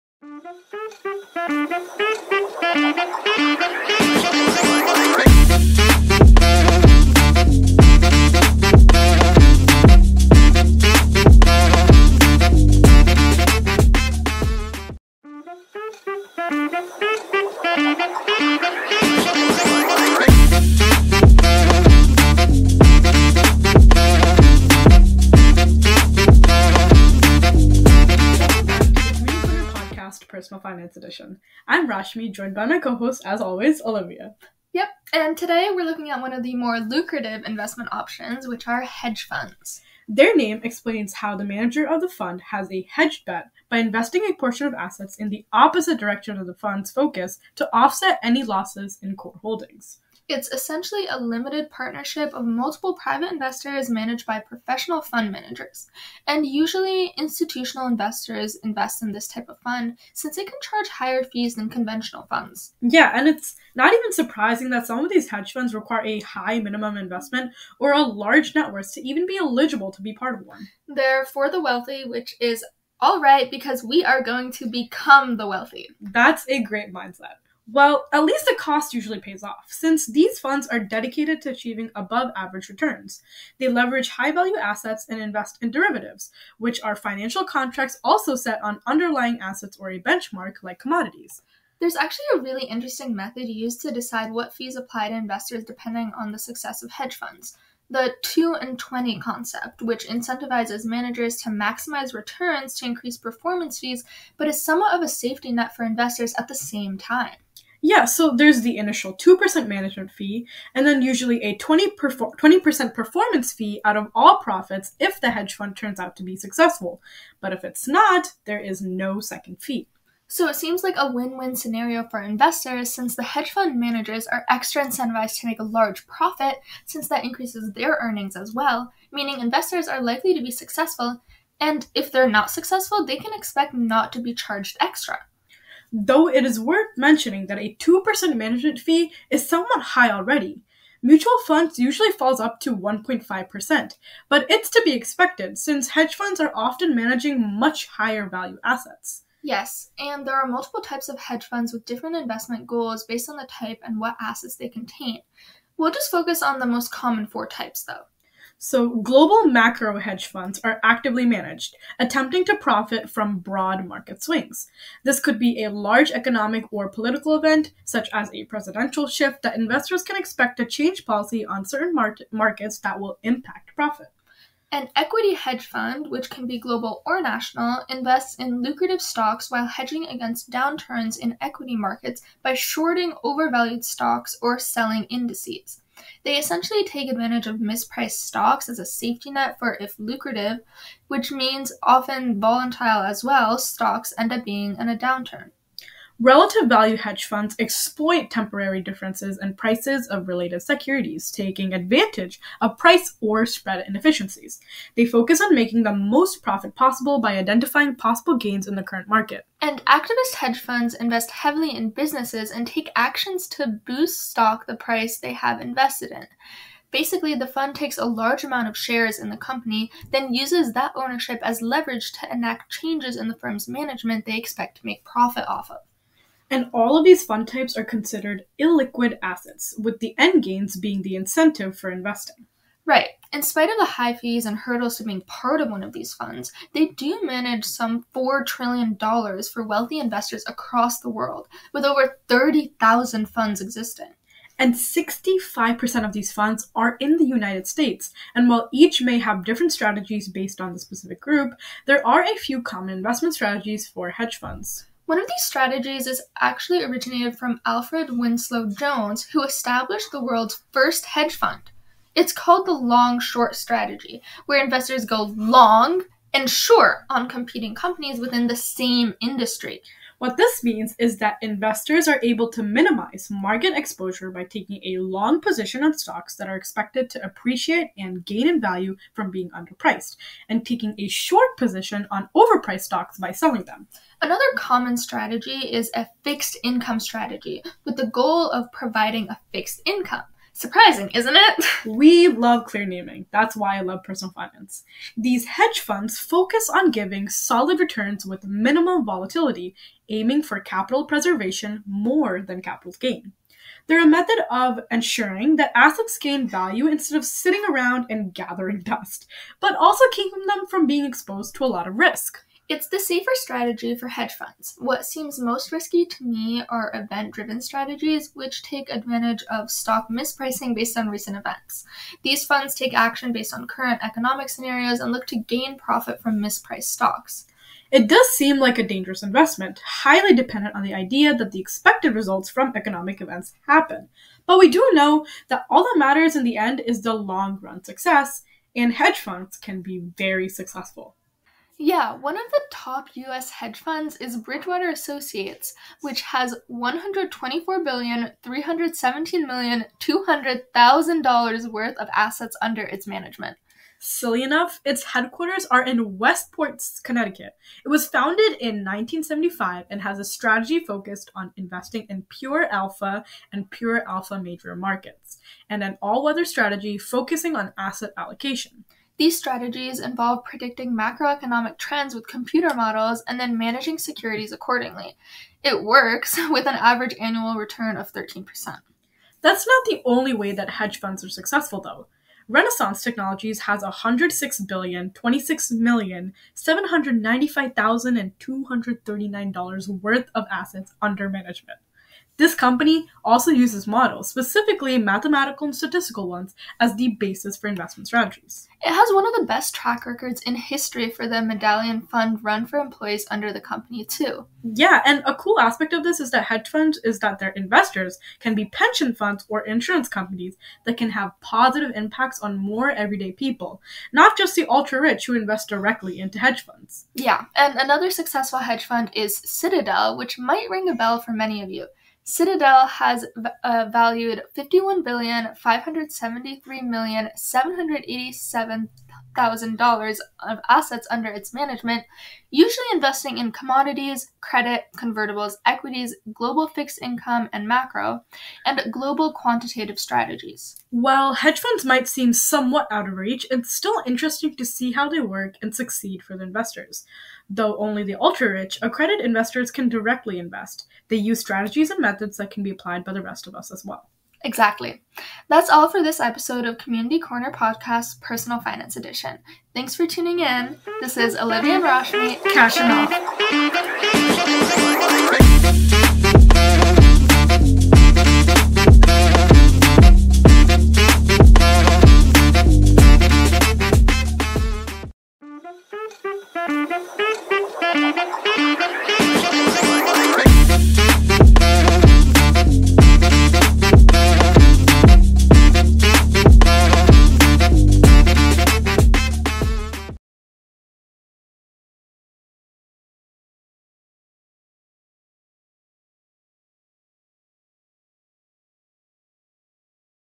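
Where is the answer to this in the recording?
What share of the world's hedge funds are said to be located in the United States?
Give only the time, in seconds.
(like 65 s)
244 s.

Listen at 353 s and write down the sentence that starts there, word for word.
Silly enough, its headquarters are in Westport, Connecticut.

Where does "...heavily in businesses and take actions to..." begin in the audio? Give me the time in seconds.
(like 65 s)
211 s.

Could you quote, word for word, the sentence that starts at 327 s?
It does seem like a dangerous investment, highly dependent on the idea that the expected results from economic events happen.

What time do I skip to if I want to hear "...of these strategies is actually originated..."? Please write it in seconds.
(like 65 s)
255 s.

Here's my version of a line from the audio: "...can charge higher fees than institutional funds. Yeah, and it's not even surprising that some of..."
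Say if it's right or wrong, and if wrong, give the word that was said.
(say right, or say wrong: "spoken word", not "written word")
wrong: "conventional", not "institutional".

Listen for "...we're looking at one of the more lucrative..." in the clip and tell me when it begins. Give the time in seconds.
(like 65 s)
35 s.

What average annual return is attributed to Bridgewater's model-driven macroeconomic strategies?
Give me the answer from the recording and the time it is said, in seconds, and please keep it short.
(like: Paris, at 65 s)
13%, at 378 s.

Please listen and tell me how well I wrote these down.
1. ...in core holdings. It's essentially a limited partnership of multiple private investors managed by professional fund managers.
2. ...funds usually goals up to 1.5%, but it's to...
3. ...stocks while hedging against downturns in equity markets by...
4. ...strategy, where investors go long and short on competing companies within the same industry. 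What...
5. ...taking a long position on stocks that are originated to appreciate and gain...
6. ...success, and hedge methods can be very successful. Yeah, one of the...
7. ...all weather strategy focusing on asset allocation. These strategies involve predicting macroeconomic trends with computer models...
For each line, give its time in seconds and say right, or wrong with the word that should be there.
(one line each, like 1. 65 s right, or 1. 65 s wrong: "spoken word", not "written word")
1. 49 s right
2. 141 s wrong: "falls", not "goals"
3. 179 s right
4. 263 s right
5. 274 s wrong: "expected", not "originated"
6. 337 s wrong: "funds", not "methods"
7. 365 s right.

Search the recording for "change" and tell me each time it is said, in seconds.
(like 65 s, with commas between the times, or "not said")
170 s, 222 s.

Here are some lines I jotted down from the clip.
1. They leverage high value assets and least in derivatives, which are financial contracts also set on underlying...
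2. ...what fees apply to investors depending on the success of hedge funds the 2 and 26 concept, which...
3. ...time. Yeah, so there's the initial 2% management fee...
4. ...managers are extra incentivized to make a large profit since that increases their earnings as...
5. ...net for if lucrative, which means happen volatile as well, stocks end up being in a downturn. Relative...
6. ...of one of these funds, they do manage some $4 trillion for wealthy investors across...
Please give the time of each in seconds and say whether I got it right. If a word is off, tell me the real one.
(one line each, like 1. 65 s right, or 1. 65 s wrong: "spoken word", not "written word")
1. 83 s wrong: "invest", not "least"
2. 94 s wrong: "20", not "26"
3. 106 s right
4. 123 s right
5. 189 s wrong: "often", not "happen"
6. 235 s right.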